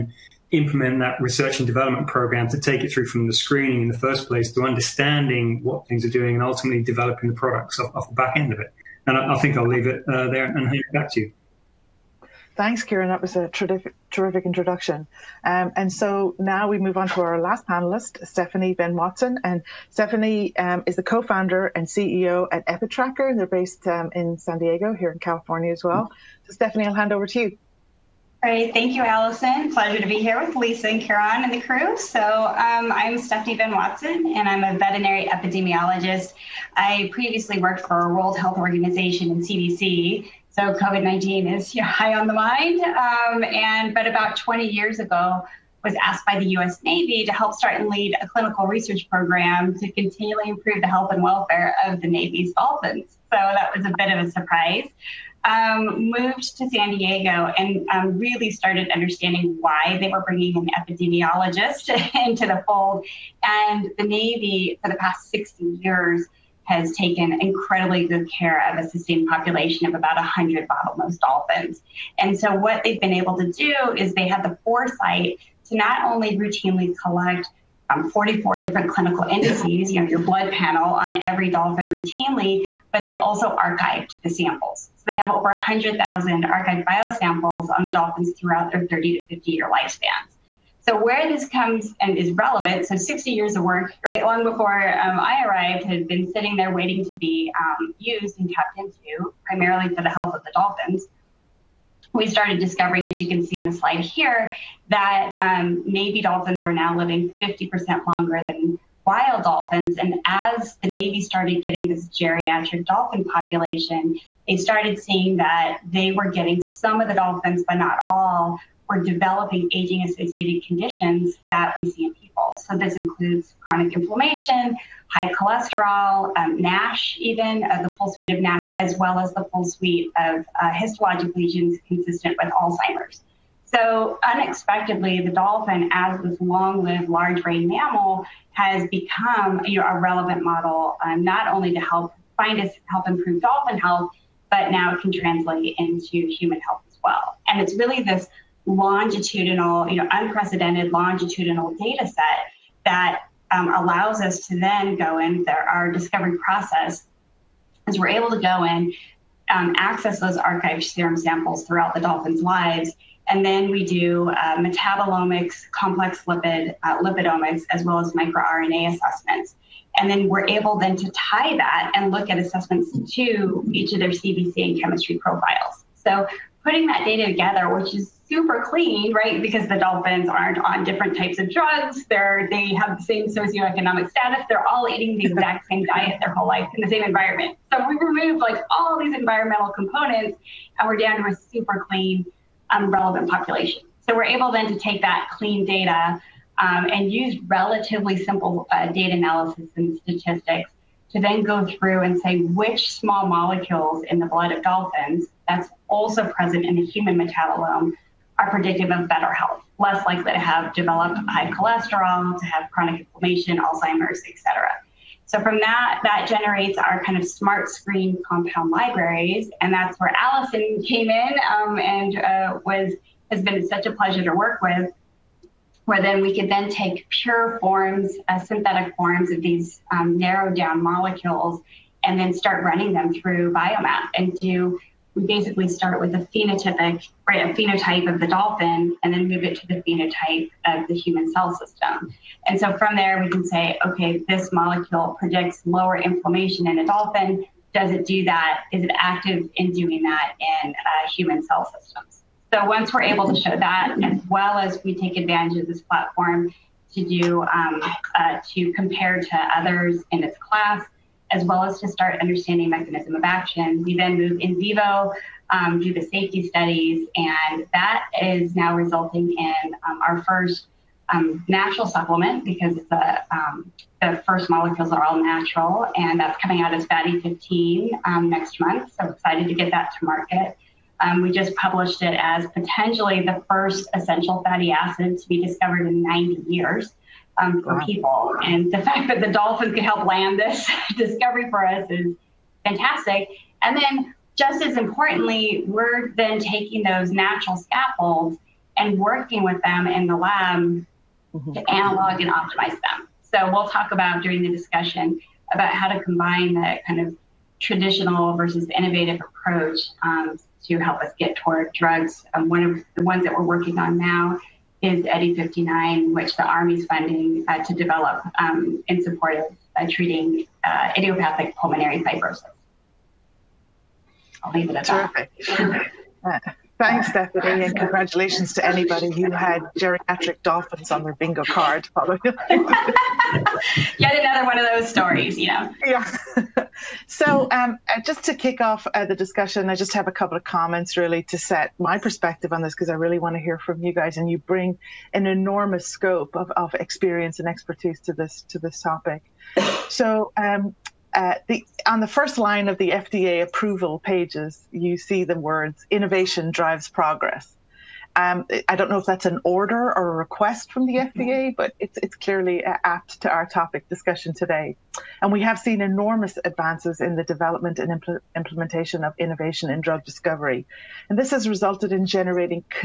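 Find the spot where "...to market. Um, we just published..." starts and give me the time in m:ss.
4:39.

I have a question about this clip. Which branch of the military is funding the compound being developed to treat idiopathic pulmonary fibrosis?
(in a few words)
the Army.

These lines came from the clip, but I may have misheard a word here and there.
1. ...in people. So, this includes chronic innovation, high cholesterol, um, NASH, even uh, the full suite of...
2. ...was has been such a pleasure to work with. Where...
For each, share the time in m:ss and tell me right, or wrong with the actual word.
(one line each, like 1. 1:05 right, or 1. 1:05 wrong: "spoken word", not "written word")
1. 2:02 wrong: "inflammation", not "innovation"
2. 3:42 right.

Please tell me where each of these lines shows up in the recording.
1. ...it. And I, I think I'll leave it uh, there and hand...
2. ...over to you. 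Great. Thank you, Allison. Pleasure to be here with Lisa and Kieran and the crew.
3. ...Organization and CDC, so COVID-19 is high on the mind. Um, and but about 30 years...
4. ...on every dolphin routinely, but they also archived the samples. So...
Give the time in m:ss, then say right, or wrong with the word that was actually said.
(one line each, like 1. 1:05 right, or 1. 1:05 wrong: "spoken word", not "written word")
1. 0:08 right
2. 0:27 right
3. 0:38 wrong: "20", not "30"
4. 1:20 right.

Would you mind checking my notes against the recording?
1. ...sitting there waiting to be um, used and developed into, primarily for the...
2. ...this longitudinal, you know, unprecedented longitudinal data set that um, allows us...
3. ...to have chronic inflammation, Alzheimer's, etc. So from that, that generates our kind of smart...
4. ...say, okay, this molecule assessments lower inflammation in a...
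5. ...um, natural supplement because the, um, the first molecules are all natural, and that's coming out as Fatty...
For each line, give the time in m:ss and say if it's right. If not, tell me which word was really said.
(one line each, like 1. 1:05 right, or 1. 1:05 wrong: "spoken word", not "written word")
1. 1:36 wrong: "tapped", not "developed"
2. 2:28 right
3. 3:32 right
4. 4:03 wrong: "predicts", not "assessments"
5. 4:31 right.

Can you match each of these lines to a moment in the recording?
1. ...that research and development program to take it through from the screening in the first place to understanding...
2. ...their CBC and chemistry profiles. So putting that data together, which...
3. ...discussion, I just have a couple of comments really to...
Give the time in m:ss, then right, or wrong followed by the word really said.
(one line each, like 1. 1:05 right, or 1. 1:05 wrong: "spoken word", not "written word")
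1. 0:01 right
2. 2:54 right
3. 5:39 right.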